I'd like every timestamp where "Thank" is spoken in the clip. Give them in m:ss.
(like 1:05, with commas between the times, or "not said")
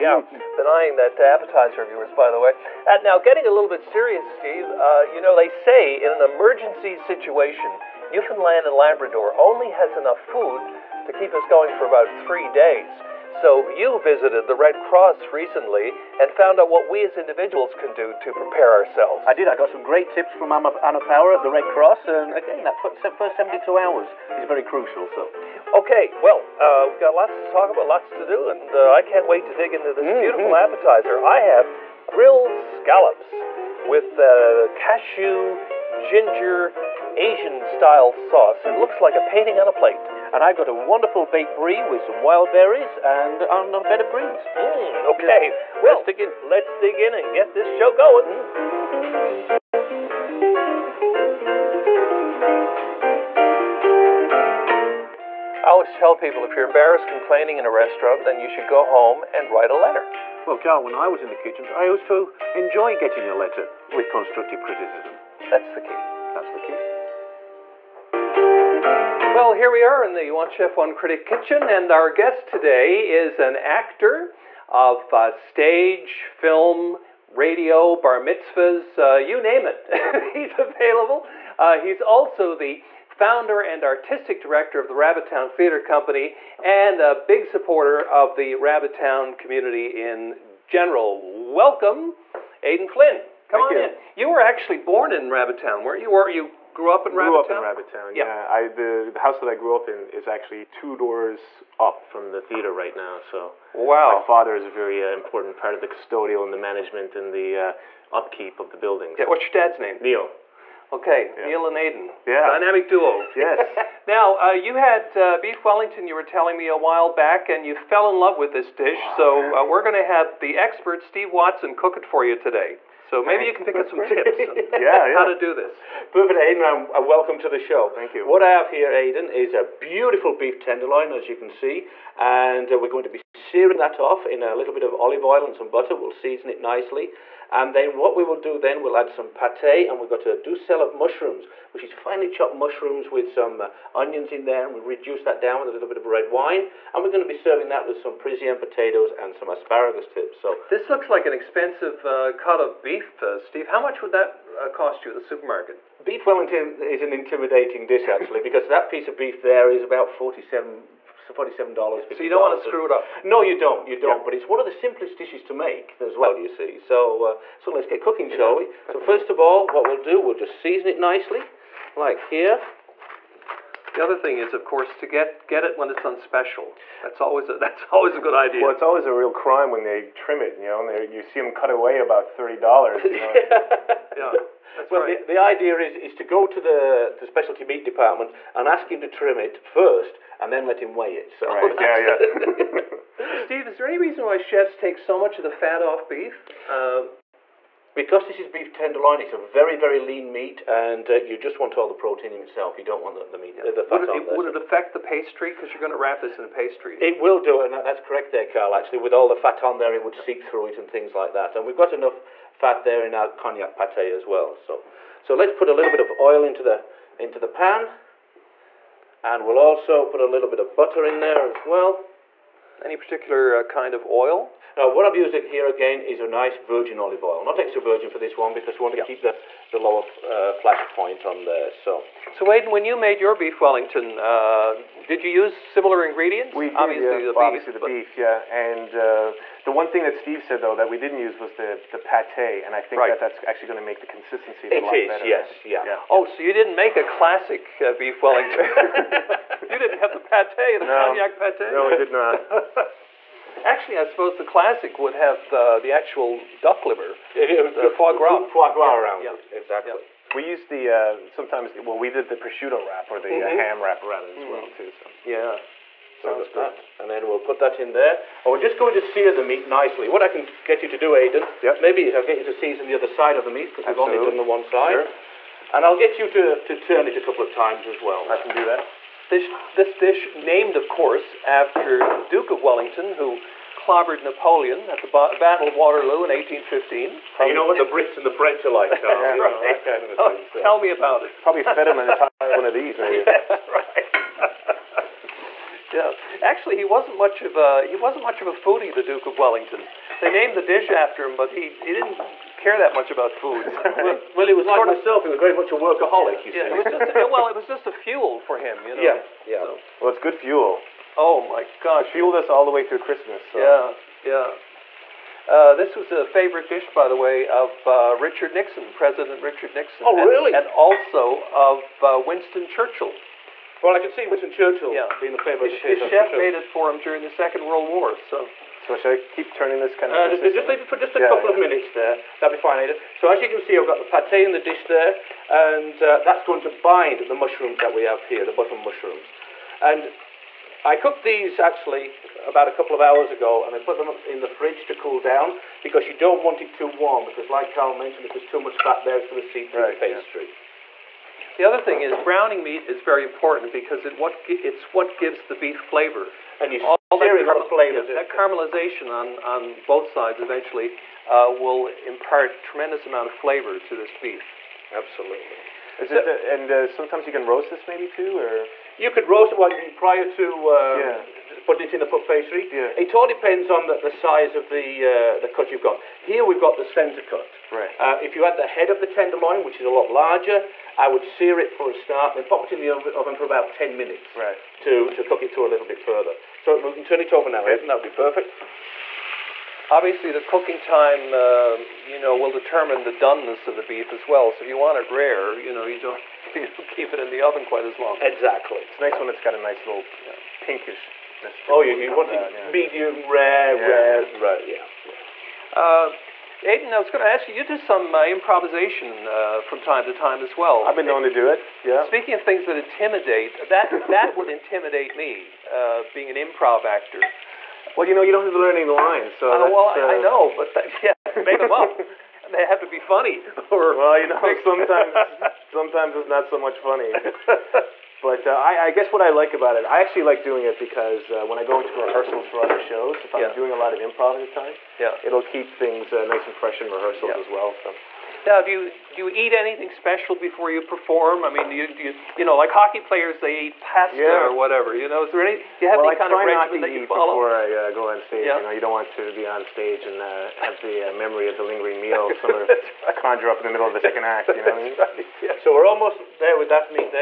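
1:33, 2:03, 2:07.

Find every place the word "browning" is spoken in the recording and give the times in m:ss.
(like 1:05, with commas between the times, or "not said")
5:52.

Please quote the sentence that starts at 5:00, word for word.
They named the dish after him, but he, he didn't care that much about food.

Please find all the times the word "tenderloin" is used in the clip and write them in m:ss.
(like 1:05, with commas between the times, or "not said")
2:10, 3:18, 6:19.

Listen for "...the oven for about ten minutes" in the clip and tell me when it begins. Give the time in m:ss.
6:22.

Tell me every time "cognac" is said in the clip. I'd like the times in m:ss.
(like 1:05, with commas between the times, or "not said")
3:33, 4:11.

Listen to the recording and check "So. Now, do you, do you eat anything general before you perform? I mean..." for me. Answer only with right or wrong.
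wrong.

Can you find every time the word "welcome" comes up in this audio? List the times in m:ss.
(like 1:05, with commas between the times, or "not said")
1:31, 2:07.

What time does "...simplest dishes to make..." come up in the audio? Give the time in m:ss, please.
2:44.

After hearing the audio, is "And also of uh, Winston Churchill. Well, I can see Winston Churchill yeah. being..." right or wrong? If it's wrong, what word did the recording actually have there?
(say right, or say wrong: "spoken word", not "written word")
right.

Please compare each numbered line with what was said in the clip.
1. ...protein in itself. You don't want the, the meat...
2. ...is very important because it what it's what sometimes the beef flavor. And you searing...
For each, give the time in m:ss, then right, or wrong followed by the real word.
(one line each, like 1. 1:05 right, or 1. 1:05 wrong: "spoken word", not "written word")
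1. 3:21 right
2. 5:52 wrong: "gives", not "sometimes".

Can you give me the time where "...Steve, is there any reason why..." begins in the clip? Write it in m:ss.
3:13.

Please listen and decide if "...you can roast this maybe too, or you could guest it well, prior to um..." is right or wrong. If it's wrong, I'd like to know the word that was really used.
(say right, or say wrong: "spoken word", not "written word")
wrong: "roast", not "guest".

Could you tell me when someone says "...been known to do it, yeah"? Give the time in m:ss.
6:50.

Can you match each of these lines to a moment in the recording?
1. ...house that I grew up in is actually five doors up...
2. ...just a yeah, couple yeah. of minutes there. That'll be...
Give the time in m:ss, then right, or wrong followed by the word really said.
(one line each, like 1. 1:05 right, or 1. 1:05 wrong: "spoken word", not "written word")
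1. 1:39 wrong: "two", not "five"
2. 5:30 right.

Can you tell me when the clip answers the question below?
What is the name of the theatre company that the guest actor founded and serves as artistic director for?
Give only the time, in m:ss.
1:24.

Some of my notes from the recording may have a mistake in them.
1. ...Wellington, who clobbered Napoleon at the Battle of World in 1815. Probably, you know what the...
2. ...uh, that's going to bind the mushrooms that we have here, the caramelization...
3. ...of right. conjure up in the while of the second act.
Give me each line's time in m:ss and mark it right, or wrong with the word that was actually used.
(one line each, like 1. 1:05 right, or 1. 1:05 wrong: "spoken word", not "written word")
1. 4:42 wrong: "Waterloo", not "World"
2. 5:36 wrong: "button", not "caramelization"
3. 7:32 wrong: "middle", not "while".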